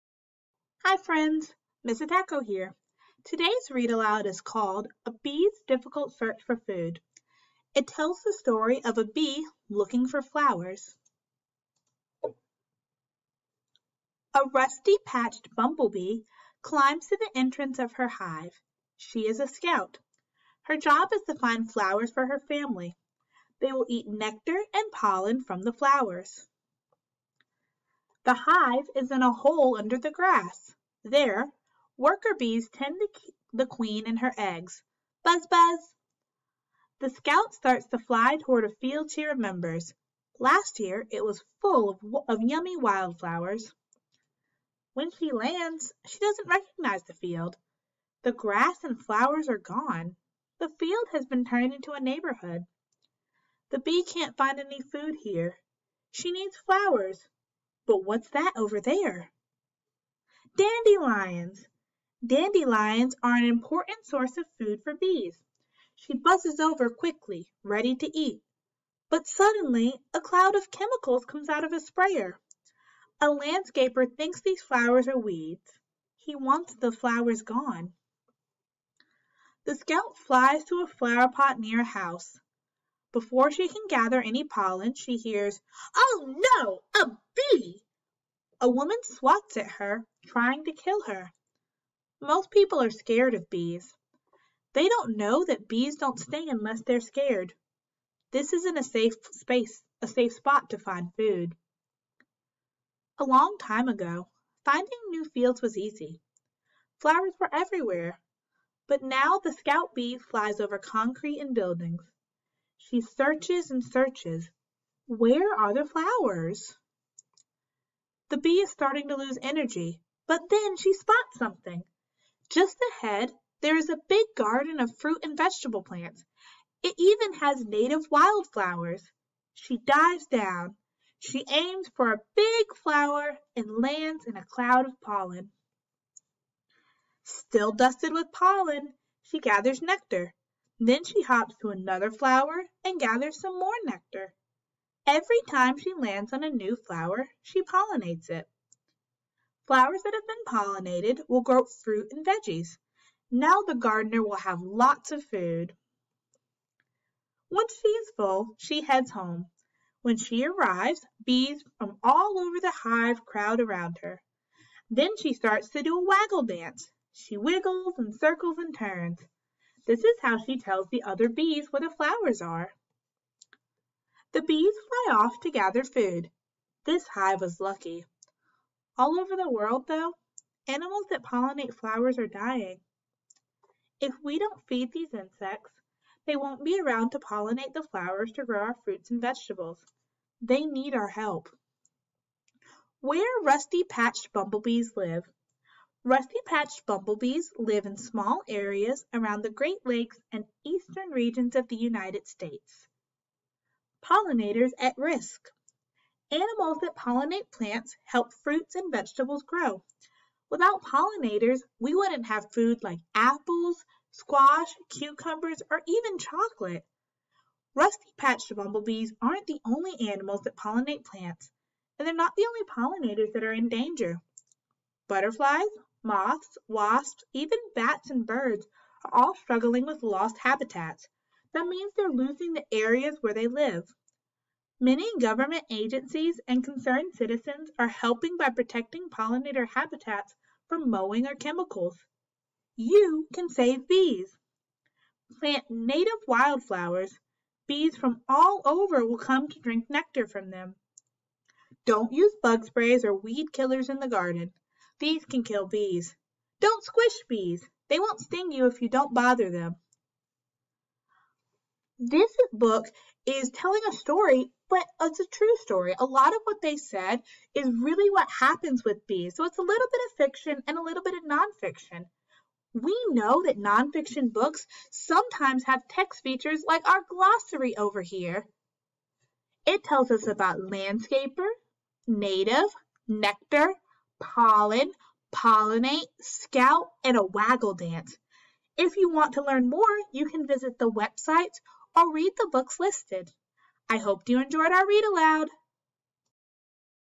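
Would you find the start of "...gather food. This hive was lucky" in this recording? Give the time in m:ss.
2:55.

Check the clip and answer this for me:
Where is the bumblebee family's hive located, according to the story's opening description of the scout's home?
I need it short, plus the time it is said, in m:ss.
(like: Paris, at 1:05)
A hole under the grass, at 0:29.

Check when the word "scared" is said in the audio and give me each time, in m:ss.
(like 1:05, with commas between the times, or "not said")
1:32, 1:37.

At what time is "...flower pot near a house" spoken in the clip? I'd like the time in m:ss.
1:20.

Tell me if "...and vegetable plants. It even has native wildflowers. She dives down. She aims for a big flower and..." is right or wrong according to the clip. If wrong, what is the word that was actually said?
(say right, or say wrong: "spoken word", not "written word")
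right.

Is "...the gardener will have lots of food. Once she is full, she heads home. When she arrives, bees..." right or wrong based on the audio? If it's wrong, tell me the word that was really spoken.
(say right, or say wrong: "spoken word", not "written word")
right.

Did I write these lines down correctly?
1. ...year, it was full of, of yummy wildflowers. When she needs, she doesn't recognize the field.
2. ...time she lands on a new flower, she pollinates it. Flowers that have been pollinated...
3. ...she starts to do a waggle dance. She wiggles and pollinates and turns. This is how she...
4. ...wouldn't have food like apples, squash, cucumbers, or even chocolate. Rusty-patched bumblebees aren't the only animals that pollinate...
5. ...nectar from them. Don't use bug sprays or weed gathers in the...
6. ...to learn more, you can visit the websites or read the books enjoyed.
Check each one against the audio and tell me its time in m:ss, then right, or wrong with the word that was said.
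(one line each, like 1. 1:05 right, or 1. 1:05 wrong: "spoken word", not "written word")
1. 0:40 wrong: "lands", not "needs"
2. 2:25 right
3. 2:45 wrong: "circles", not "pollinates"
4. 3:31 right
5. 4:09 wrong: "killers", not "gathers"
6. 4:49 wrong: "listed", not "enjoyed".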